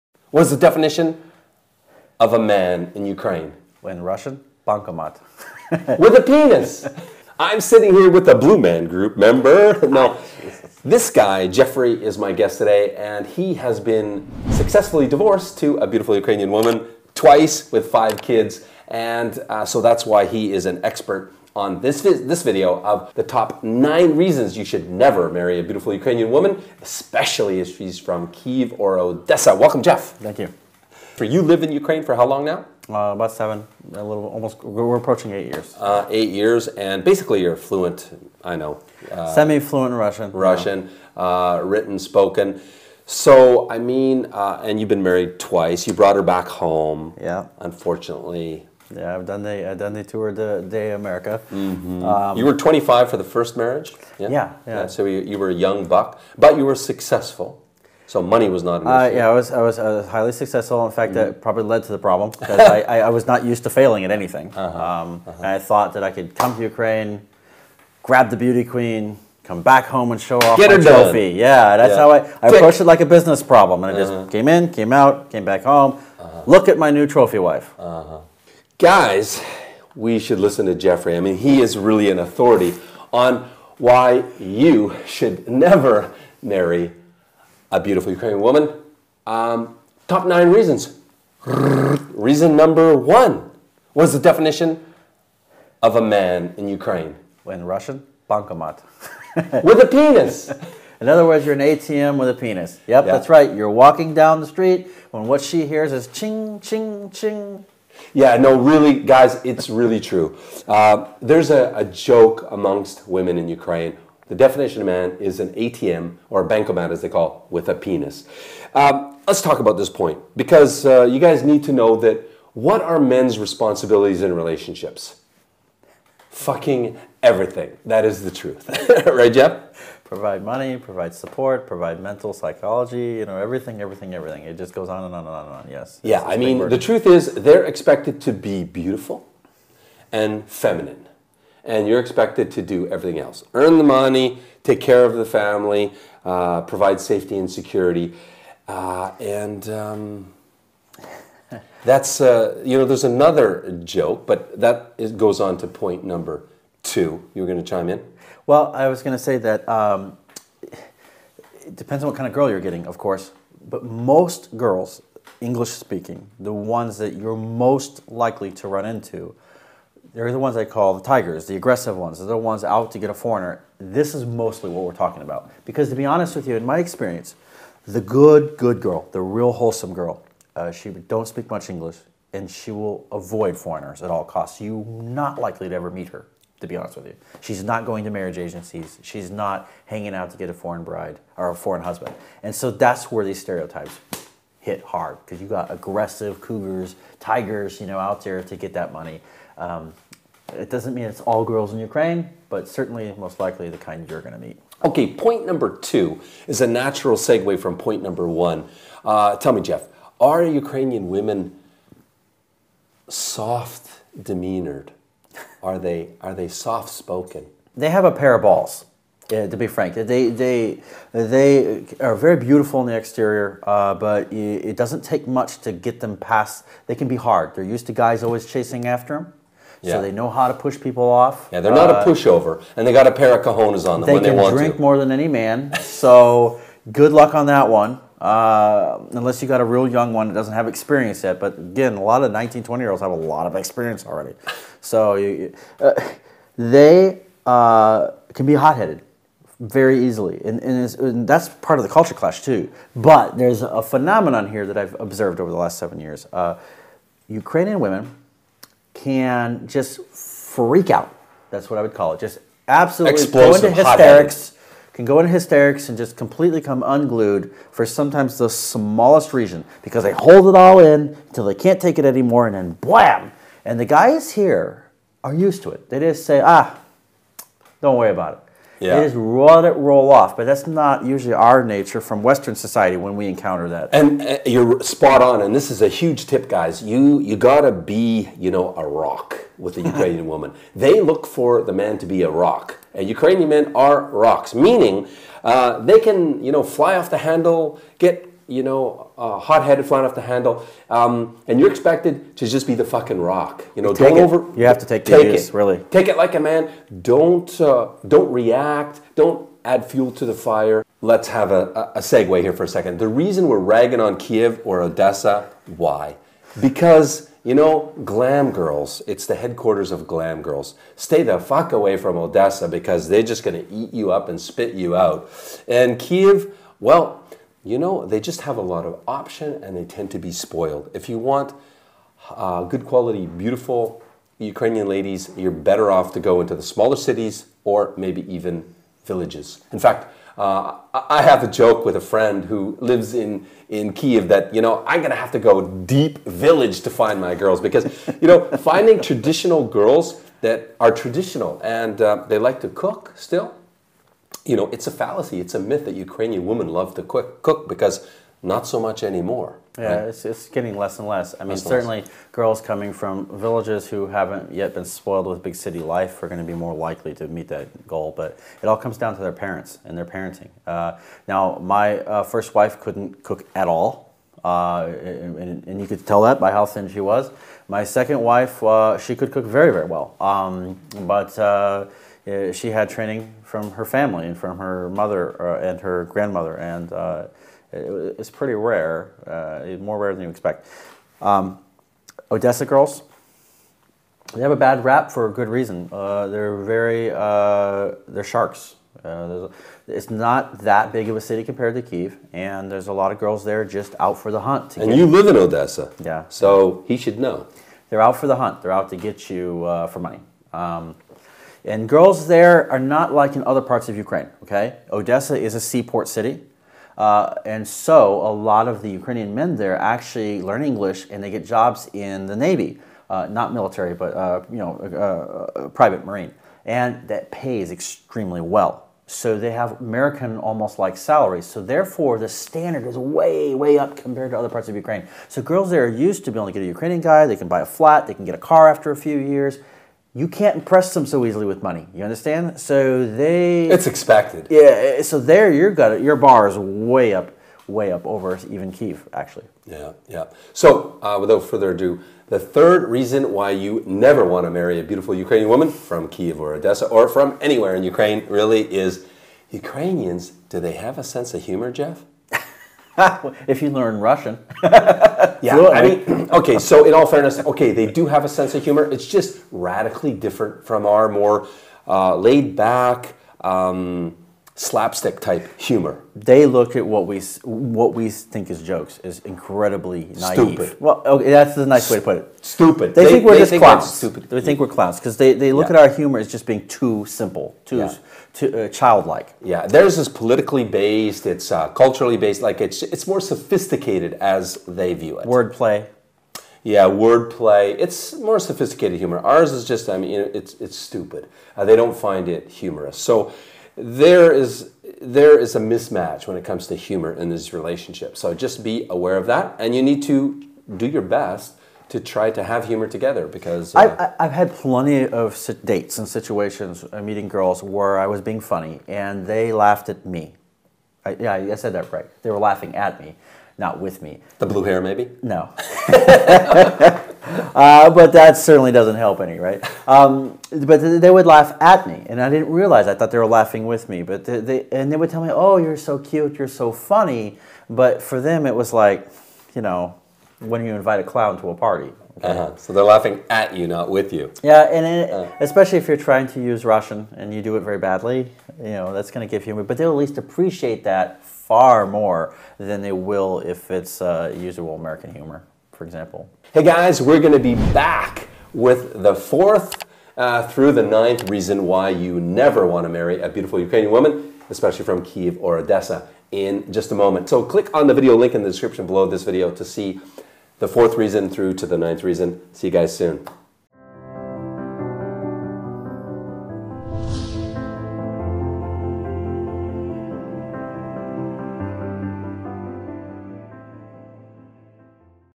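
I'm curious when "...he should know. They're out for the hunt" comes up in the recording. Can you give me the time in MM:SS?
06:46.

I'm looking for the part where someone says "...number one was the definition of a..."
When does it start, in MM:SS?
01:32.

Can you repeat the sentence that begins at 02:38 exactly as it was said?
Well, I was going to say that um, it depends on what kind of girl you're getting, of course.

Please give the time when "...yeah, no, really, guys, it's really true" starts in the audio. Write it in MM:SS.
01:48.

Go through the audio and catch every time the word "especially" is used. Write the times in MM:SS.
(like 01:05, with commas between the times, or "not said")
00:26, 09:05, 09:24.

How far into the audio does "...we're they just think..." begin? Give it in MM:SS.
08:03.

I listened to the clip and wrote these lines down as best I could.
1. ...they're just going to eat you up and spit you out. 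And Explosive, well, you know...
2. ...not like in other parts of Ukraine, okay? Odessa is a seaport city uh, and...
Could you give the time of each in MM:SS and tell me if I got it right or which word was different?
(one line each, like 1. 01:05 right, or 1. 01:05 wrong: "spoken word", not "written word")
1. 05:23 wrong: "Kiev", not "Explosive"
2. 06:52 right.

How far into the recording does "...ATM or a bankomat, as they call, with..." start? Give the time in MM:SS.
01:55.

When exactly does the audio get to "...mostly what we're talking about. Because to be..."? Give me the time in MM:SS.
02:54.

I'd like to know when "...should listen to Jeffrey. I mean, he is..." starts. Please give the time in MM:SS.
01:20.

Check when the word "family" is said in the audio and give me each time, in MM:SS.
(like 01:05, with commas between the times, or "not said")
02:25, 06:23.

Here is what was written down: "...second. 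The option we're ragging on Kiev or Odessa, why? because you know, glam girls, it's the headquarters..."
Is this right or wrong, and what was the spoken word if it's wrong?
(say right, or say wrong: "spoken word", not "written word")
wrong: "reason", not "option".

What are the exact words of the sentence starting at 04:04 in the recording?
So you, uh, they uh, can be hot headed very easily.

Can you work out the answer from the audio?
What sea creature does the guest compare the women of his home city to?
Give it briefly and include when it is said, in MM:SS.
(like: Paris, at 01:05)
sharks, at 06:38.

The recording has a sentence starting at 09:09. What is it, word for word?
But they'll at least appreciate that far more than they will if it's uh, usable American humor for example.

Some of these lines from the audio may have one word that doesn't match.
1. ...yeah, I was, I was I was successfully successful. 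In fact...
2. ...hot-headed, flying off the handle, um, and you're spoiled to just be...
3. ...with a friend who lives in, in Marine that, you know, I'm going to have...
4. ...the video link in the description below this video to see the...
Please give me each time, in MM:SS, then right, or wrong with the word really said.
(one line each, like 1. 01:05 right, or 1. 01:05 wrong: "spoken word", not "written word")
1. 00:59 wrong: "highly", not "successfully"
2. 04:59 wrong: "expected", not "spoiled"
3. 05:41 wrong: "Kiev", not "Marine"
4. 09:27 right.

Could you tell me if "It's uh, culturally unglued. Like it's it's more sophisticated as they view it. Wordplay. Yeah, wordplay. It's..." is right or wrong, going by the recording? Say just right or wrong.
wrong.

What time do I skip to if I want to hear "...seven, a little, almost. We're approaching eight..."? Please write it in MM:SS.
00:33.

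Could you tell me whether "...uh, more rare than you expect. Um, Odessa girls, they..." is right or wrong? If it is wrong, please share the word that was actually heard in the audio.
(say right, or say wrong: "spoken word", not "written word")
right.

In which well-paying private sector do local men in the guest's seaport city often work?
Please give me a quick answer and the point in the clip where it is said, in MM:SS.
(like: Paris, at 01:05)
private Marine, at 07:05.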